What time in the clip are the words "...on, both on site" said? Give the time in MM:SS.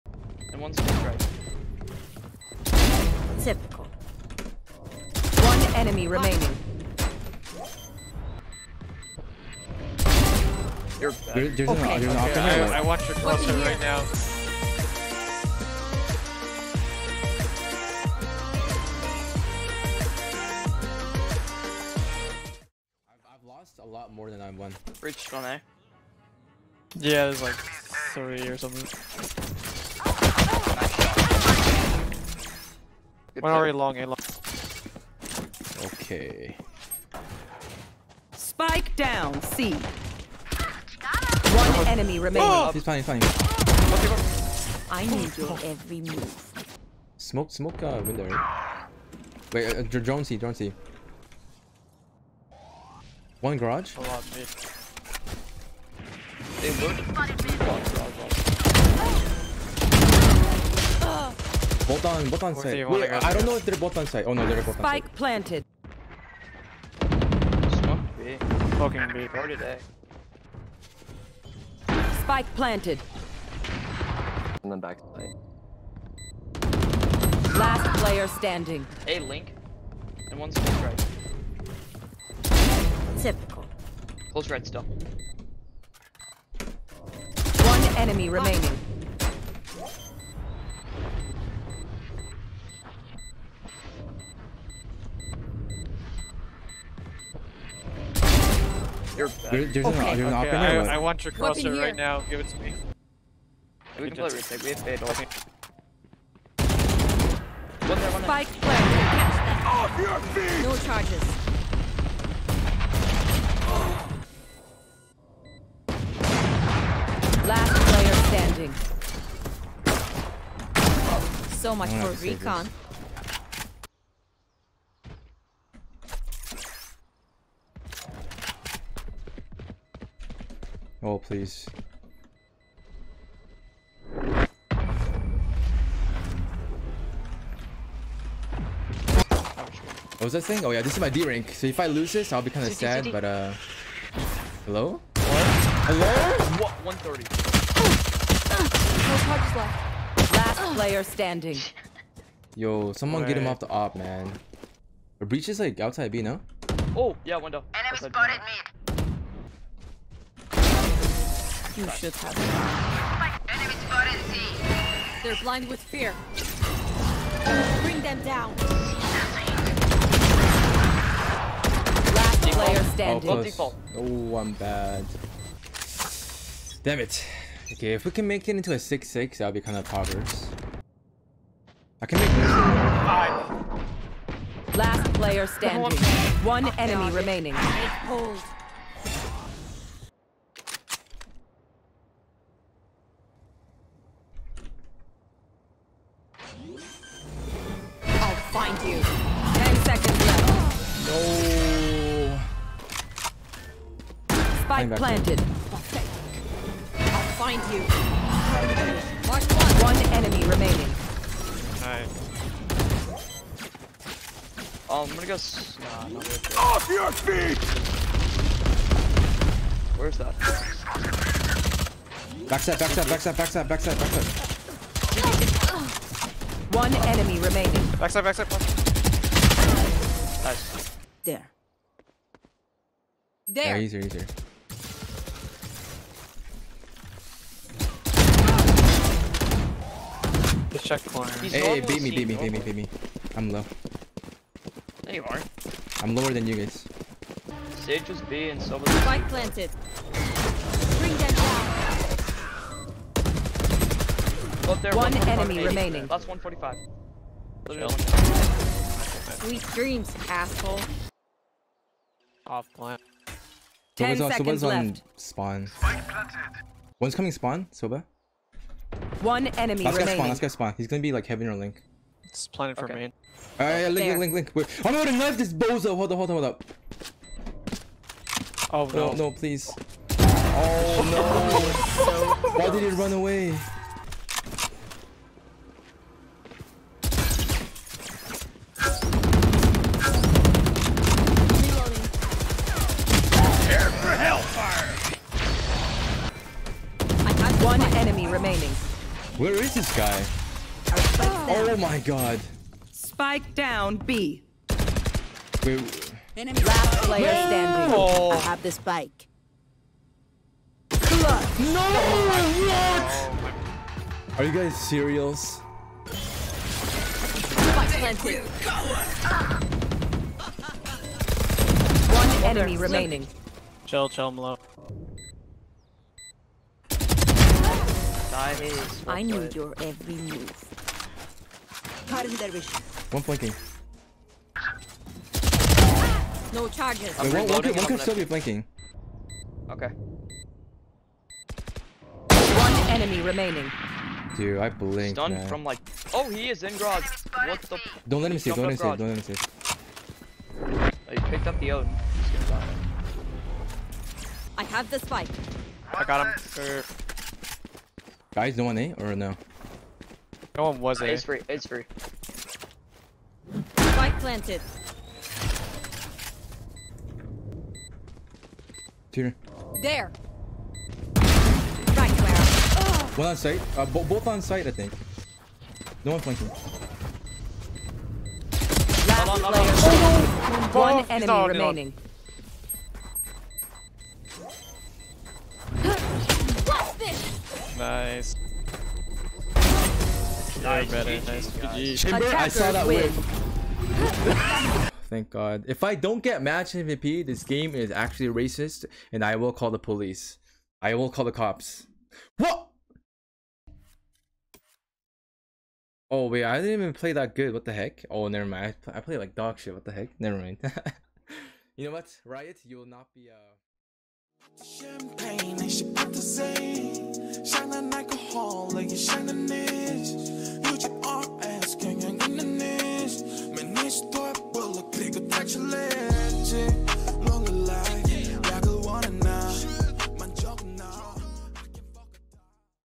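01:02.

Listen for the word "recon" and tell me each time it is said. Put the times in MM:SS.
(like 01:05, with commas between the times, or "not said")
02:02.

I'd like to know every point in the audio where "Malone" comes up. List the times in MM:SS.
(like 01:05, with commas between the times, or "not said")
05:24.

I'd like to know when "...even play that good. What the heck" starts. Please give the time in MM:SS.
06:46.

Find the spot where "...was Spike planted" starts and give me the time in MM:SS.
04:08.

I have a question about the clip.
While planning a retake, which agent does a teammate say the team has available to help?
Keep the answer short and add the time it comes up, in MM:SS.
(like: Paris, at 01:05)
Fade, at 01:44.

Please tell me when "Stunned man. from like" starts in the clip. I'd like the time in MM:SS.
05:45.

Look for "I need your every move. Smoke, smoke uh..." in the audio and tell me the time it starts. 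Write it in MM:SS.
00:44.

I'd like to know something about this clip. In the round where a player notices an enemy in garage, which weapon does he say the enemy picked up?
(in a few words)
Odin.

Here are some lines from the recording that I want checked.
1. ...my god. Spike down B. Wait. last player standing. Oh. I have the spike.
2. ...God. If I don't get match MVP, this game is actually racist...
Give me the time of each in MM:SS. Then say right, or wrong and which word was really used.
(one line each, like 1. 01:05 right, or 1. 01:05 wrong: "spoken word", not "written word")
1. 05:01 right
2. 06:35 right.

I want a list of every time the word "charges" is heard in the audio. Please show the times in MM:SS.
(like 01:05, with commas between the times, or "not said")
01:50, 05:36.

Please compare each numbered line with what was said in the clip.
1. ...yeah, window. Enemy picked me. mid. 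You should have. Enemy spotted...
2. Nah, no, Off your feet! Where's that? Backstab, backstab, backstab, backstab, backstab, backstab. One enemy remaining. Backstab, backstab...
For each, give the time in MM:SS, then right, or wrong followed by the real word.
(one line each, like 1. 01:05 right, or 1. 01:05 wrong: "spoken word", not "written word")
1. 02:37 wrong: "spotted", not "picked"
2. 03:35 right.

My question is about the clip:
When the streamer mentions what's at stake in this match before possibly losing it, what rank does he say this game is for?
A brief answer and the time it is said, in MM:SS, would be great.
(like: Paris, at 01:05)
D rank, at 02:21.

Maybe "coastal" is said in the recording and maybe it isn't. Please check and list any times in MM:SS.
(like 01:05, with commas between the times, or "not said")
not said.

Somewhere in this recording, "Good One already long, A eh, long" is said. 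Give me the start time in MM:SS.
00:33.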